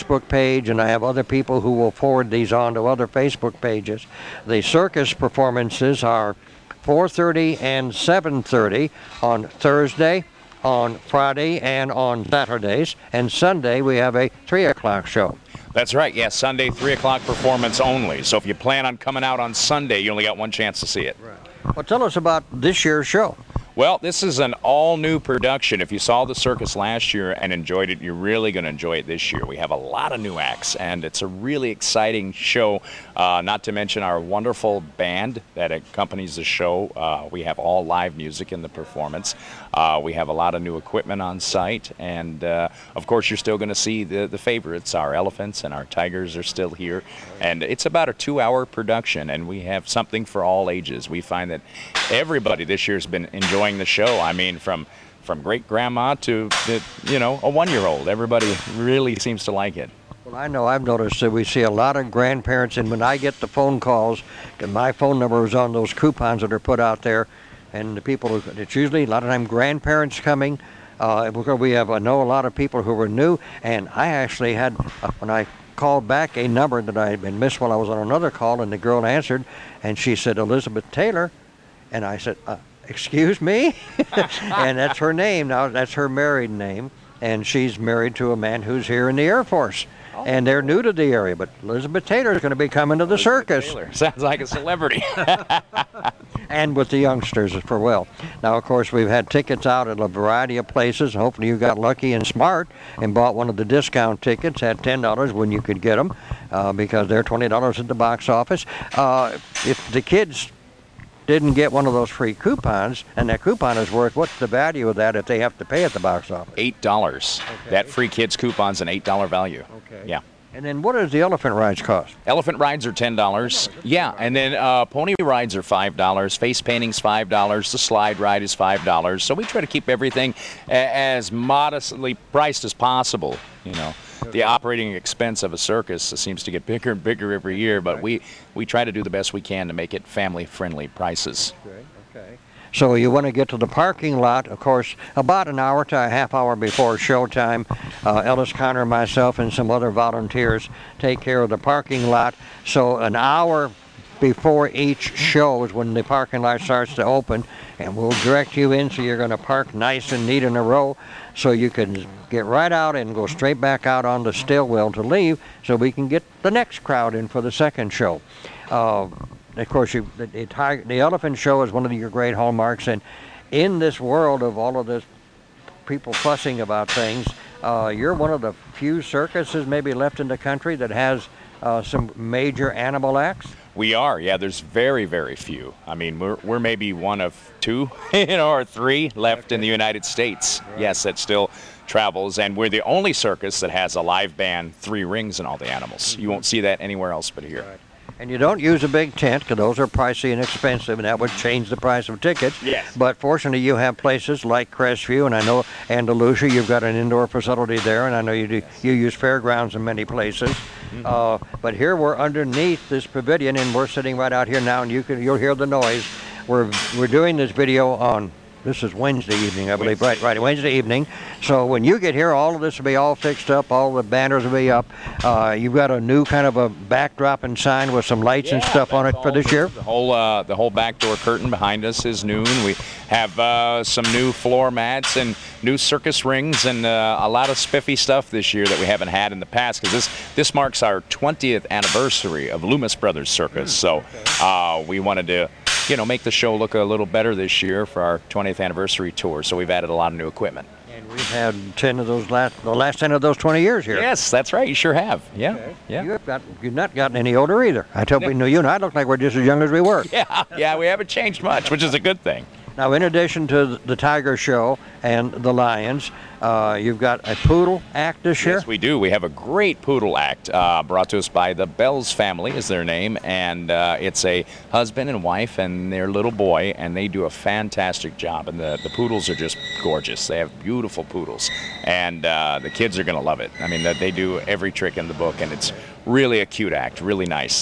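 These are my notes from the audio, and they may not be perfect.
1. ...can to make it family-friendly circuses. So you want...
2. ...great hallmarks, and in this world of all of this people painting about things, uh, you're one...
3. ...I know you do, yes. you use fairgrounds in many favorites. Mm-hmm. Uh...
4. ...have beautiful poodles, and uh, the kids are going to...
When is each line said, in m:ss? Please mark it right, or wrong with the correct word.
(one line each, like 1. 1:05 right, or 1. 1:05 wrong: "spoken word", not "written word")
1. 2:19 wrong: "prices", not "circuses"
2. 2:52 wrong: "fussing", not "painting"
3. 3:28 wrong: "places", not "favorites"
4. 4:40 right.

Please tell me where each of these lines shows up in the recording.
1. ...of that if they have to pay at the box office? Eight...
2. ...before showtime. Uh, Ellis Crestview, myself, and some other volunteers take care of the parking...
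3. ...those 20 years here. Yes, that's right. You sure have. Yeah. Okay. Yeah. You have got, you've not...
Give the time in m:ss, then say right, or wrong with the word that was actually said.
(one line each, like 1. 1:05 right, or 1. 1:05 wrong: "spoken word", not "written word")
1. 1:54 right
2. 2:26 wrong: "Connor", not "Crestview"
3. 4:13 right.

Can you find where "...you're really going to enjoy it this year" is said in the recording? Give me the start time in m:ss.
0:28.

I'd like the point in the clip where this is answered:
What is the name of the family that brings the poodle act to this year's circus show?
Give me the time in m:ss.
4:31.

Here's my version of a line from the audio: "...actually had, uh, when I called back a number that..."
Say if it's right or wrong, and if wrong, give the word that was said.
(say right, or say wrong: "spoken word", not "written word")
right.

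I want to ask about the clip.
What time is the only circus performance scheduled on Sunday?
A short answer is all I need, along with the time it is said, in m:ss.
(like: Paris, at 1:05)
3 o'clock, at 0:16.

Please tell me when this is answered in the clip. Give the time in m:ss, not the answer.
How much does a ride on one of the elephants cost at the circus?
2:02.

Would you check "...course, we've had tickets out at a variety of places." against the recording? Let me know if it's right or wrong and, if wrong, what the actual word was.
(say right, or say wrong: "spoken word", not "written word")
right.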